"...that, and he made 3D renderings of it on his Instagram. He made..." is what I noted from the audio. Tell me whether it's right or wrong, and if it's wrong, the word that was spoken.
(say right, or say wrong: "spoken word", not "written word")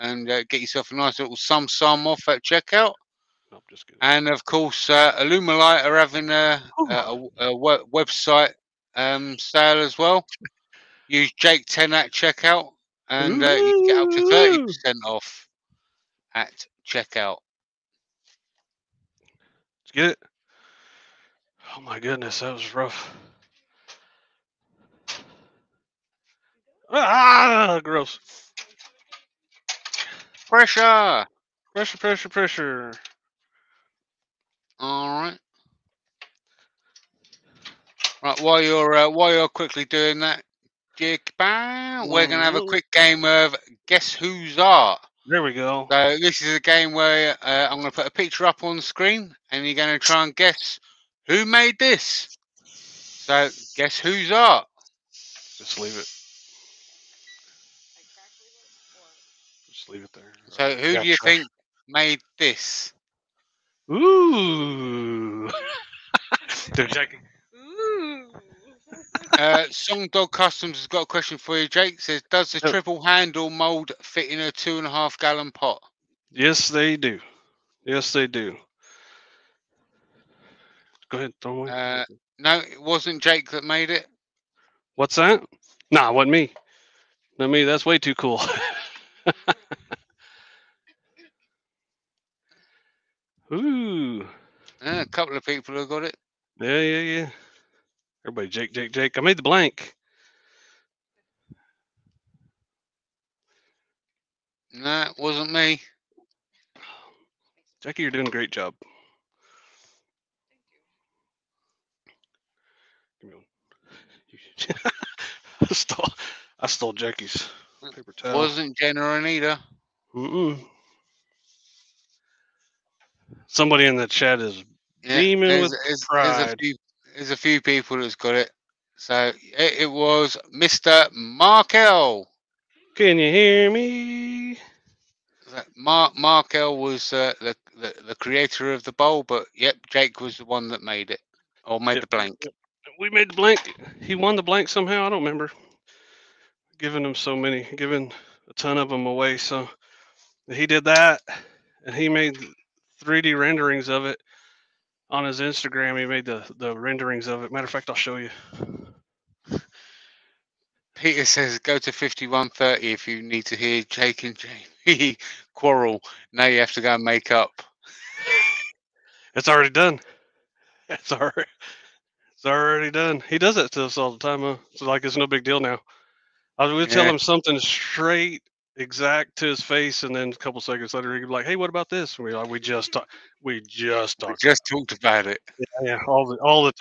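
right.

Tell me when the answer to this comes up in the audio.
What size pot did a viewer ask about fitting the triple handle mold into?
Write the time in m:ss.
1:14.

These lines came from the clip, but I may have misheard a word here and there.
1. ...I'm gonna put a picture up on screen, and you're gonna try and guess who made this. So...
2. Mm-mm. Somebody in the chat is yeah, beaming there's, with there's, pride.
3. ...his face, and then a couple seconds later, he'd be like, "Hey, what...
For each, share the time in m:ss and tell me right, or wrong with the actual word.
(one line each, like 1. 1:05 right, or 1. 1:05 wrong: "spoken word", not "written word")
1. 0:47 right
2. 2:00 right
3. 2:59 right.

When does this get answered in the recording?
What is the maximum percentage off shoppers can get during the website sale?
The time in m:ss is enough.
0:14.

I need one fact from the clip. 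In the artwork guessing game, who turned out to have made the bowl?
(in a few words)
Mark Markel.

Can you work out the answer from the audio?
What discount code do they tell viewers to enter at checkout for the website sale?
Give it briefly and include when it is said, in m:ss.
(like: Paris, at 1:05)
Jake 10, at 0:11.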